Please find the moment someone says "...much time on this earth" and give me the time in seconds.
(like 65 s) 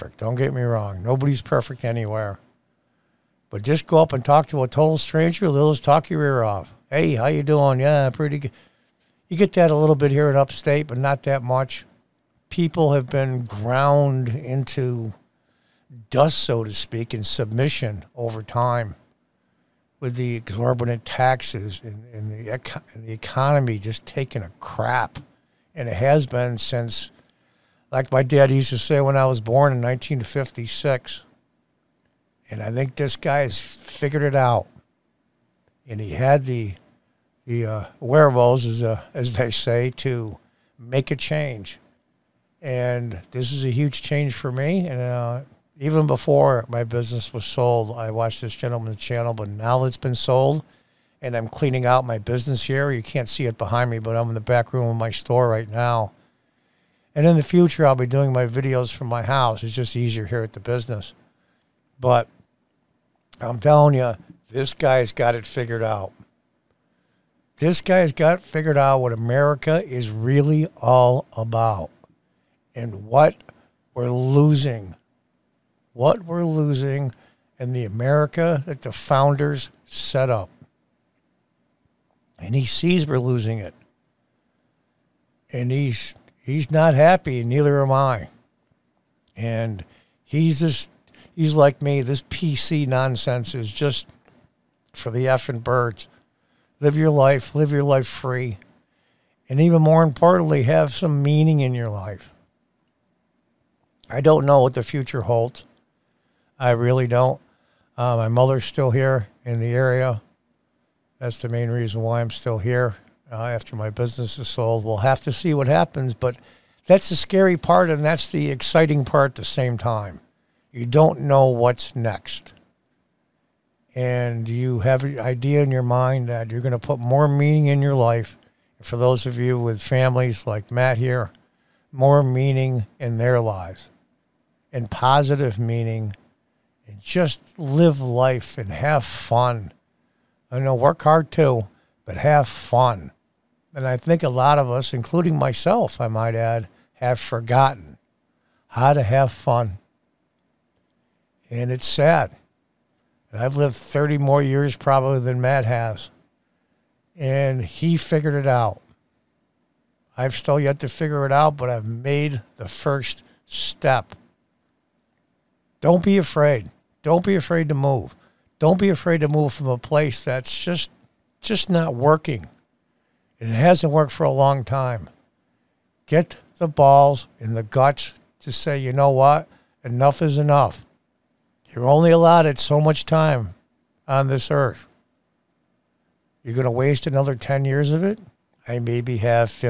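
182 s.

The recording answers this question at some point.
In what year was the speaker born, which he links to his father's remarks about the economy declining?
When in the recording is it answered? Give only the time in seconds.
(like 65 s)
29 s.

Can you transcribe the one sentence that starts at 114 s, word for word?
We'll have to see what happens, but that's the scary part and that's the exciting part at the same time.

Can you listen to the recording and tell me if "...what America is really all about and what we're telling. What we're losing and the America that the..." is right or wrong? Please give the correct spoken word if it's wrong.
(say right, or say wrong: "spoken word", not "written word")
wrong: "losing", not "telling".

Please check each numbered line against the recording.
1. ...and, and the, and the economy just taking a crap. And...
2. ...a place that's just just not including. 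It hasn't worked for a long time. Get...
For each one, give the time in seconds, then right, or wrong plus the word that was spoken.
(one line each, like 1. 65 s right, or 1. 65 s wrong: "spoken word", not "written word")
1. 21 s right
2. 169 s wrong: "working", not "including".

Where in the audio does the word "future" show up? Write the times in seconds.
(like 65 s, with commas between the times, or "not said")
57 s, 104 s.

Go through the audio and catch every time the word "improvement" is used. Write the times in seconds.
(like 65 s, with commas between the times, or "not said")
not said.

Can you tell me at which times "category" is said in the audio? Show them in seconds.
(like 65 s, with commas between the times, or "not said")
not said.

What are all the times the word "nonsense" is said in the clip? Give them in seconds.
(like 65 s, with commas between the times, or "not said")
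92 s.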